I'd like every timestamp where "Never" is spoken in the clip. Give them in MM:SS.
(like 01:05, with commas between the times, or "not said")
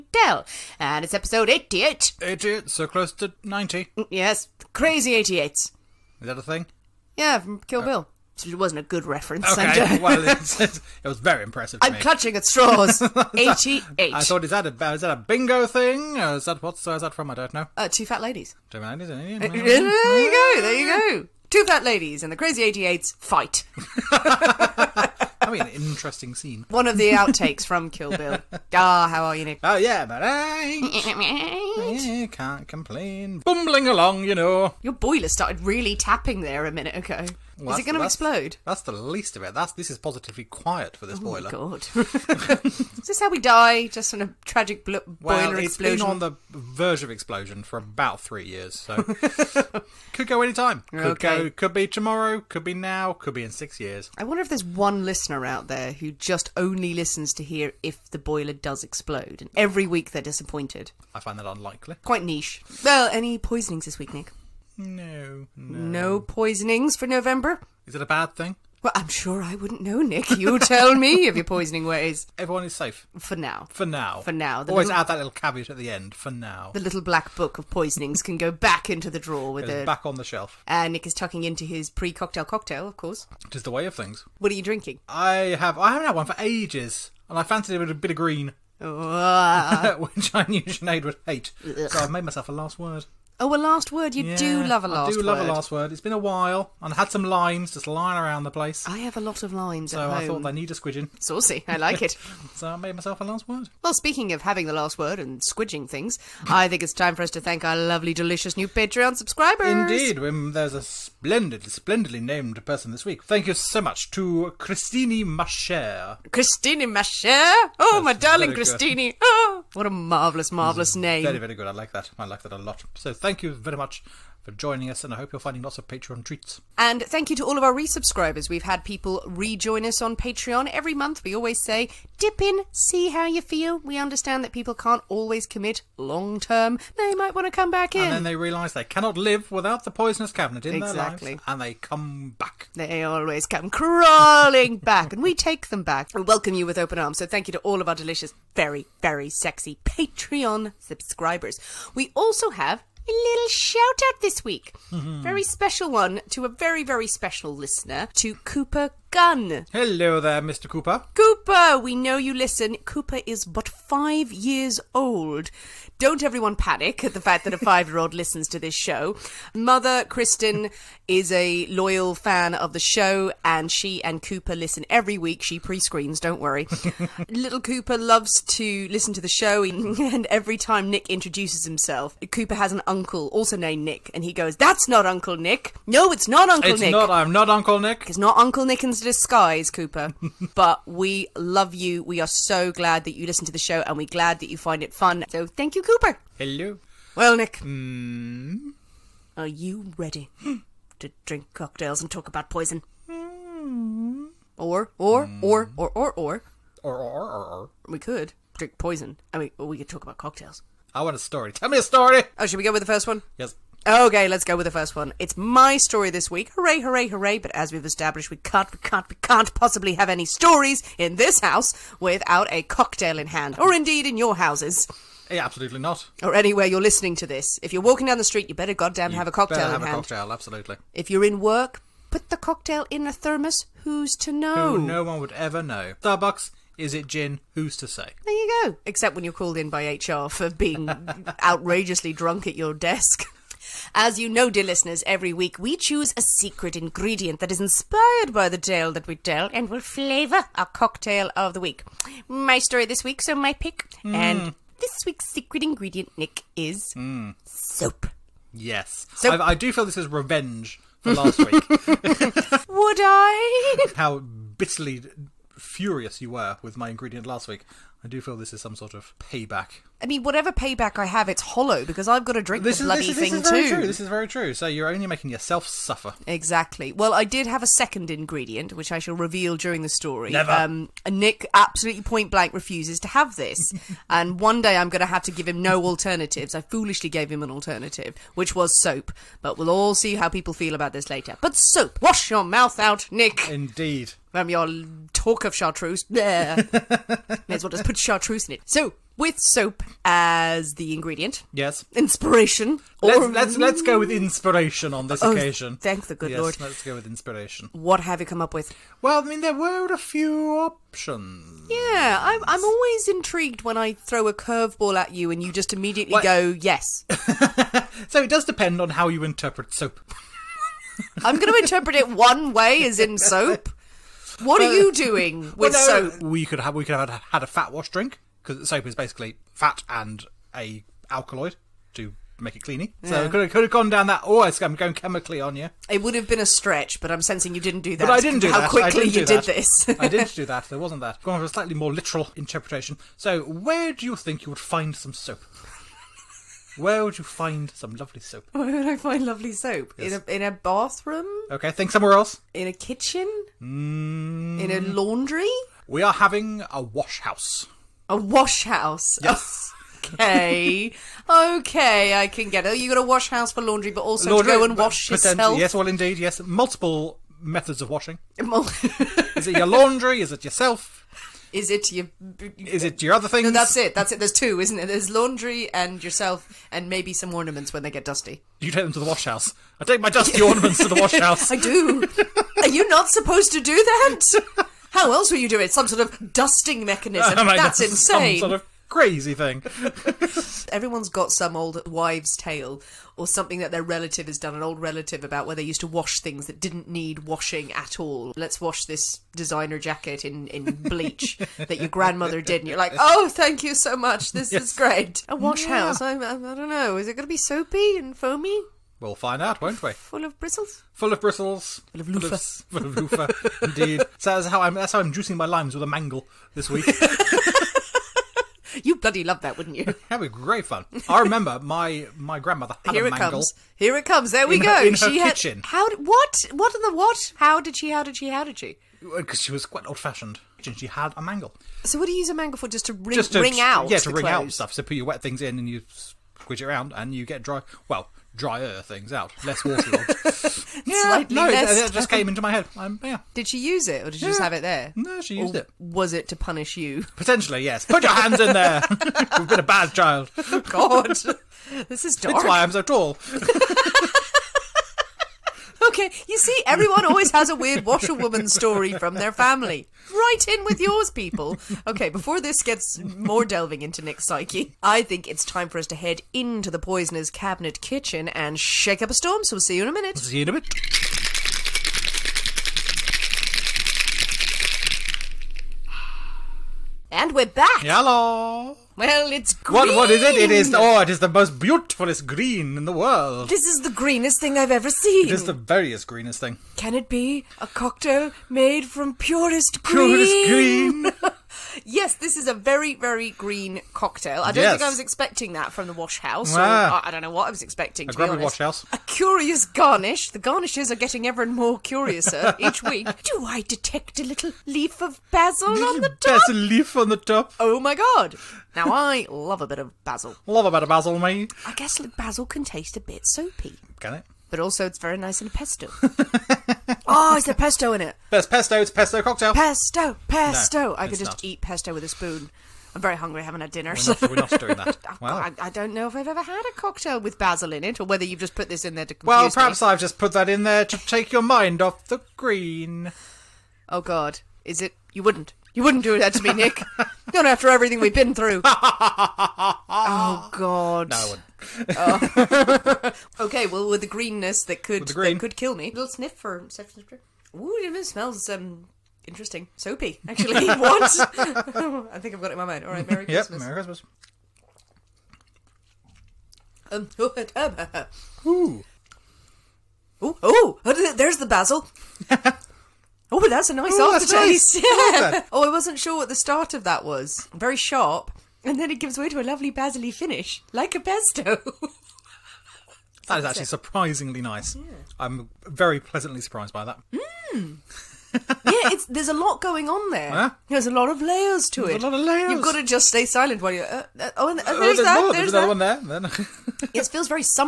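04:40.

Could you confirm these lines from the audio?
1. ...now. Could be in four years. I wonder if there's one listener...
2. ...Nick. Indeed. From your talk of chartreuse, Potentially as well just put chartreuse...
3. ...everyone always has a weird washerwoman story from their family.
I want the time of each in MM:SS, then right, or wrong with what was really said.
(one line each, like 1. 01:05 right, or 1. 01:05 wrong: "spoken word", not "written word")
1. 00:52 wrong: "six", not "four"
2. 04:53 wrong: "May", not "Potentially"
3. 07:36 right.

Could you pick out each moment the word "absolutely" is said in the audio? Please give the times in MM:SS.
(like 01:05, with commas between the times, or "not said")
03:45, 03:50, 04:41.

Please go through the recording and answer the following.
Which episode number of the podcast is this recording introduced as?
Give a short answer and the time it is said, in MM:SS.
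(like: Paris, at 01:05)
88, at 00:01.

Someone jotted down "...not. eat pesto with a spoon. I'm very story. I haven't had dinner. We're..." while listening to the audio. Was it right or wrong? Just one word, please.
wrong.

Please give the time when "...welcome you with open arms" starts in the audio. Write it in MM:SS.
02:26.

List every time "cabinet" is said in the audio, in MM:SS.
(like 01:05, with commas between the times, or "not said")
02:20, 07:47.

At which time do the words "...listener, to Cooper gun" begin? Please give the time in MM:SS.
02:37.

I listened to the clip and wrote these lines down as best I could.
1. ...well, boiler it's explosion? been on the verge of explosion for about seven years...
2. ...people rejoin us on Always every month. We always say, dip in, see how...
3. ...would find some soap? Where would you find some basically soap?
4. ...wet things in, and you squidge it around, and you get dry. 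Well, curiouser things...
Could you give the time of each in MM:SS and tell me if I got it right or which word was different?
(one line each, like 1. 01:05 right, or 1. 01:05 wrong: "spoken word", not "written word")
1. 00:45 wrong: "three", not "seven"
2. 02:08 wrong: "Patreon", not "Always"
3. 05:44 wrong: "lovely", not "basically"
4. 07:15 wrong: "drier", not "curiouser".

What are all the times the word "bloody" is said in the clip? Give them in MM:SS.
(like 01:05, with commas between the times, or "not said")
04:32, 06:58.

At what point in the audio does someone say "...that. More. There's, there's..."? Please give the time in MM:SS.
09:44.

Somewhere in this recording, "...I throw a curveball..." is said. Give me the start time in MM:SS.
05:13.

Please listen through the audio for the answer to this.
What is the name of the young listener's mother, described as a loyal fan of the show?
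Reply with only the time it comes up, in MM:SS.
02:50.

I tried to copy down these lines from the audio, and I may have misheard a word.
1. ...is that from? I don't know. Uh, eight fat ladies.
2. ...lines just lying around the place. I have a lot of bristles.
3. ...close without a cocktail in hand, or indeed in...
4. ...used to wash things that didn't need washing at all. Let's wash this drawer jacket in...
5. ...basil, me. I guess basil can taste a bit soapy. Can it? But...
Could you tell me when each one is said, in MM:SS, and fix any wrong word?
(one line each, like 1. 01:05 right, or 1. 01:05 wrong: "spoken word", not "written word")
1. 00:16 wrong: "two", not "eight"
2. 01:37 wrong: "lines", not "bristles"
3. 03:41 wrong: "house", not "close"
4. 06:35 wrong: "designer", not "drawer"
5. 08:30 right.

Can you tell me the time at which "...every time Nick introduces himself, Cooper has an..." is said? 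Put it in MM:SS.
03:00.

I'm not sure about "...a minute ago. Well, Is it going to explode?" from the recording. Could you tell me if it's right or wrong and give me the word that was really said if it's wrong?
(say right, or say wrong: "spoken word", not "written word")
right.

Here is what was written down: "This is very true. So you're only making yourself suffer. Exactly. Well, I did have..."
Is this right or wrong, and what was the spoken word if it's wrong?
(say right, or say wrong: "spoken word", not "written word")
right.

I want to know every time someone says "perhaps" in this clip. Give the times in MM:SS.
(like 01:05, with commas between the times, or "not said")
08:49.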